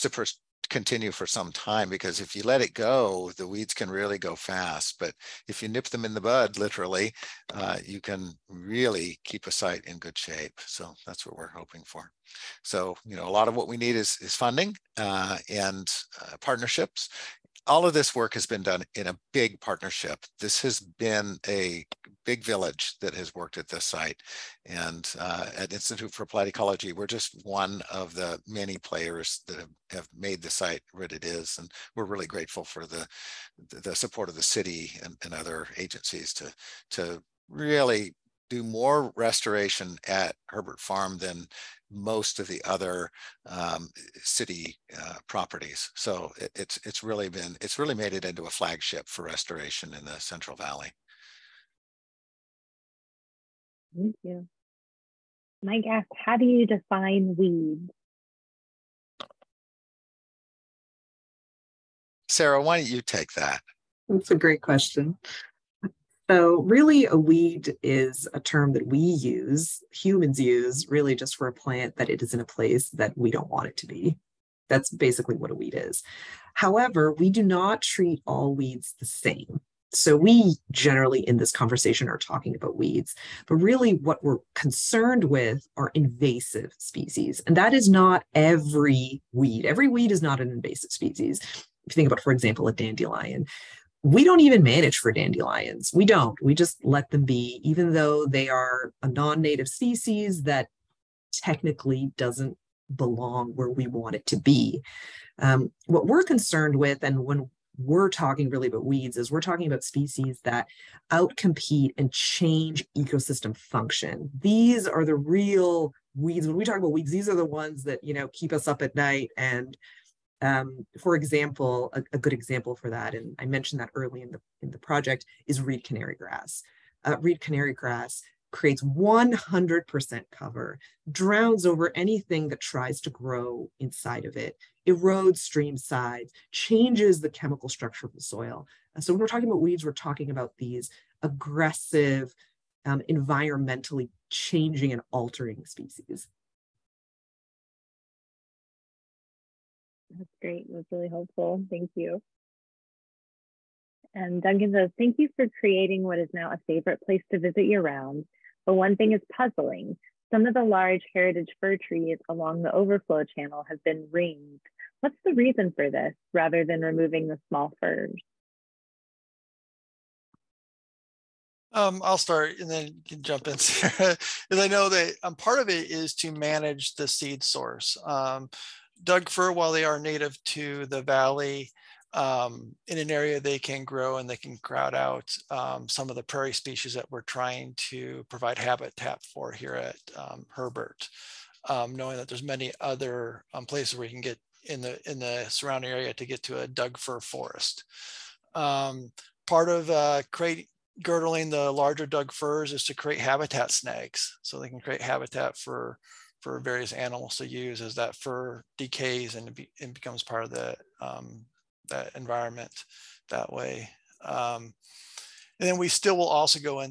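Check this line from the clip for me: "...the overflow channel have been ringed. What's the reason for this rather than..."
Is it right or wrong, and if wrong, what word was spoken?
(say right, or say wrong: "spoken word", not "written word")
right.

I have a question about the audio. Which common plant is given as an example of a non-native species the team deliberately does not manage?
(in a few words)
dandelion.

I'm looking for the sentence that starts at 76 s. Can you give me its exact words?
However, we do not treat all weeds the same.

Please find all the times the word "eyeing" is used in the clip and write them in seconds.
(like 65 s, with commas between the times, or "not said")
not said.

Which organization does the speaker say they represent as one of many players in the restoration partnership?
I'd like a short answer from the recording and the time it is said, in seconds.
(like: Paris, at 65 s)
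Institute for Applied Ecology, at 25 s.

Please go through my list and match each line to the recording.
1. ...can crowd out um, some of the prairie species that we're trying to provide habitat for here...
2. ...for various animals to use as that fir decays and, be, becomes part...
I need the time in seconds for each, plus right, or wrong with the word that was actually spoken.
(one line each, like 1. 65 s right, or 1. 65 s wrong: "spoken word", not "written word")
1. 184 s right
2. 206 s right.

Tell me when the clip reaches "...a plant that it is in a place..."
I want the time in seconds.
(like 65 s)
71 s.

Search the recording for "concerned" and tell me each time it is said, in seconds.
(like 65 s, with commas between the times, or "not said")
84 s, 106 s.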